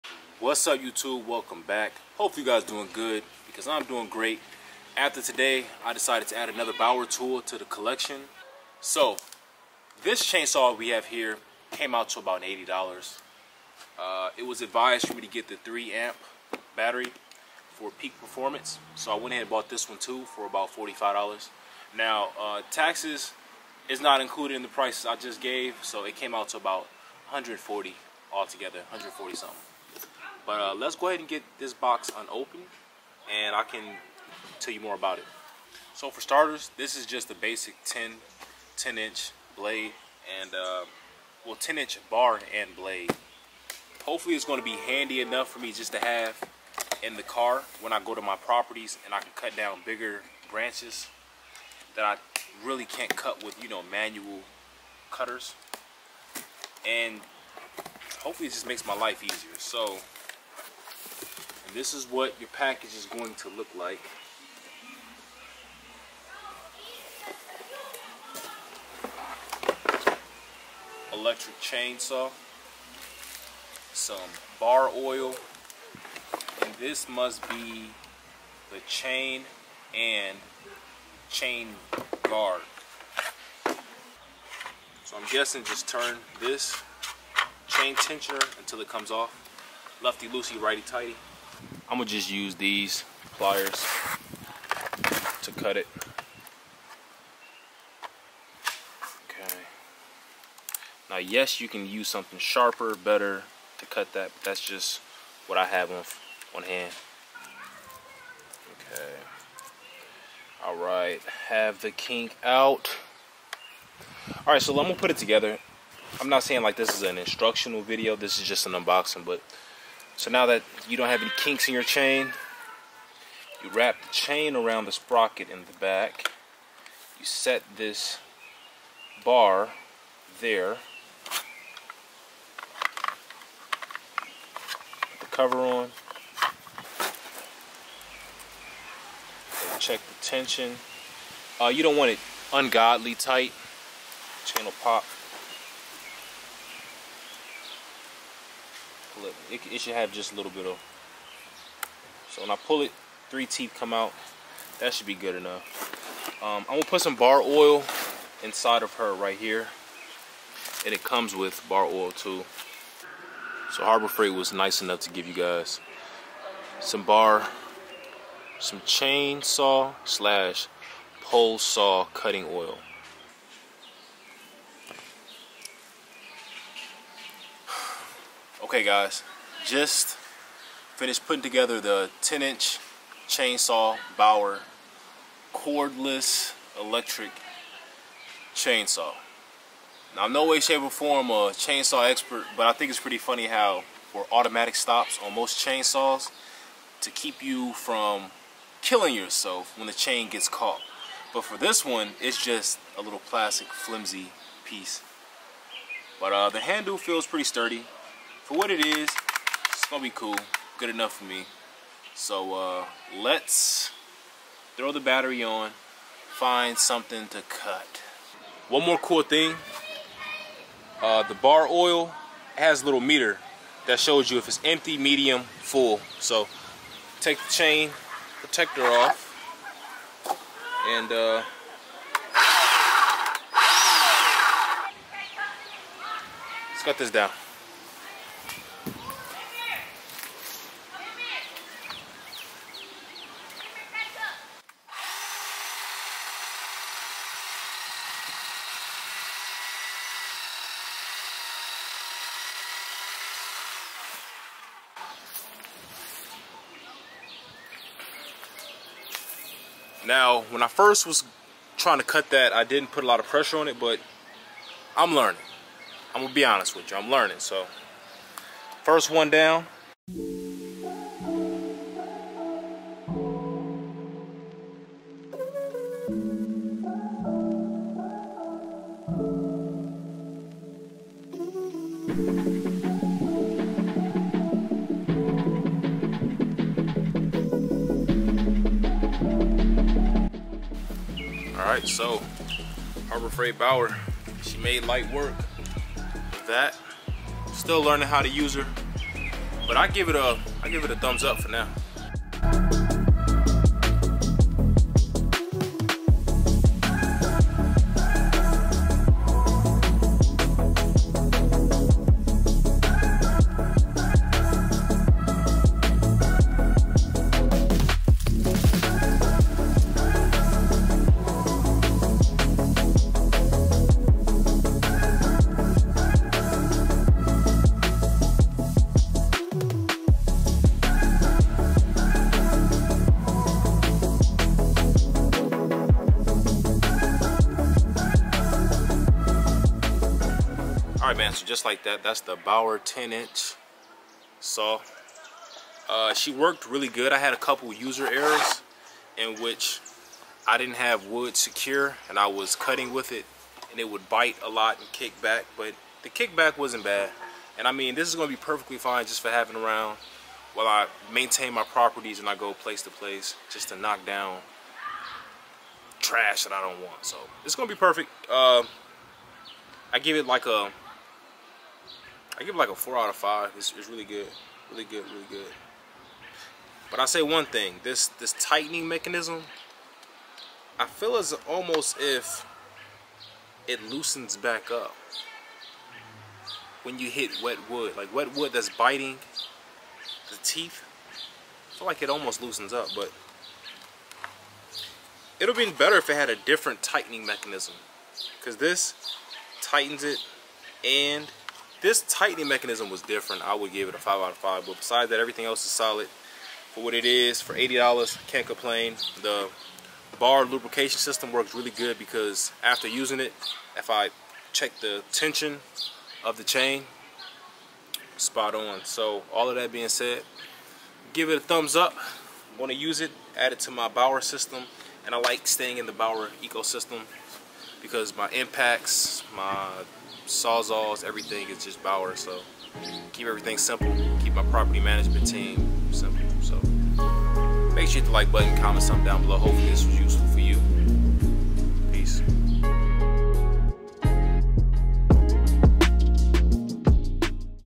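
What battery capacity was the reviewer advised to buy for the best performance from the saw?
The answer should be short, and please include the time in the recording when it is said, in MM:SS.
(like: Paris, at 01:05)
3 amp, at 00:15.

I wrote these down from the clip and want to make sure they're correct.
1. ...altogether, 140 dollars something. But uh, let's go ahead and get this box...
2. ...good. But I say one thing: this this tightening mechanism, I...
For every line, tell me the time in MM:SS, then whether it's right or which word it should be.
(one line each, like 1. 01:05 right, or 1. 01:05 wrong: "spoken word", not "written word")
1. 00:28 right
2. 06:15 right.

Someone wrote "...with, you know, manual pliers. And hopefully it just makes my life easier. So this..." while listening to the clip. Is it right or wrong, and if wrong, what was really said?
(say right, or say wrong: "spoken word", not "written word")
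wrong: "cutters", not "pliers".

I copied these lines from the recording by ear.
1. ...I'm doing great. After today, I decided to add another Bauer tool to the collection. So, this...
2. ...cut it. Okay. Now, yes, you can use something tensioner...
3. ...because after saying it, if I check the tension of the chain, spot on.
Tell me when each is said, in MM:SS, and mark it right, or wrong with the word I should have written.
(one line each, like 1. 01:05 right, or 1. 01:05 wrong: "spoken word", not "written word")
1. 00:03 right
2. 01:35 wrong: "sharper", not "tensioner"
3. 06:51 wrong: "using", not "saying".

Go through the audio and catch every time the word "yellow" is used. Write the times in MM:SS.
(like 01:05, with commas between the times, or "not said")
not said.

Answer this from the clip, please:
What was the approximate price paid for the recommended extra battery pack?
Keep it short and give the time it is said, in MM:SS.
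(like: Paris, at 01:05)
$45, at 00:20.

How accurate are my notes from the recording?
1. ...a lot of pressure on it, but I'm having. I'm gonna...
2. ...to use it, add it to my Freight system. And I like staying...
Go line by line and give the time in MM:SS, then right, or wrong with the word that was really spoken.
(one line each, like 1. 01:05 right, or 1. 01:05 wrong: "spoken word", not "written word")
1. 04:23 wrong: "learning", not "having"
2. 07:02 wrong: "Bauer", not "Freight".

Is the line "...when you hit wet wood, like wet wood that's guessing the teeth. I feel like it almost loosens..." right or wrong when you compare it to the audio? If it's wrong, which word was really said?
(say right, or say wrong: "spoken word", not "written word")
wrong: "biting", not "guessing".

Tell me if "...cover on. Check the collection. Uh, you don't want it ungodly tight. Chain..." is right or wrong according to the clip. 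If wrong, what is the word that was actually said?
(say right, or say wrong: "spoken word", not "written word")
wrong: "tension", not "collection".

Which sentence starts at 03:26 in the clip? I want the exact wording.
But uh, the handle feels pretty sturdy for what it is, it's gonna be cool, good enough for me.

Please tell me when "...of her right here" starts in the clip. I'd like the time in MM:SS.
02:38.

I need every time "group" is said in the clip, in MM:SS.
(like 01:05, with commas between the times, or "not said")
not said.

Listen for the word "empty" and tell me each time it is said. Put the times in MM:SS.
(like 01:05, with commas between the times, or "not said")
03:44.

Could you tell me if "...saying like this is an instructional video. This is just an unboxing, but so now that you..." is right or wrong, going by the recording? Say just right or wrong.
right.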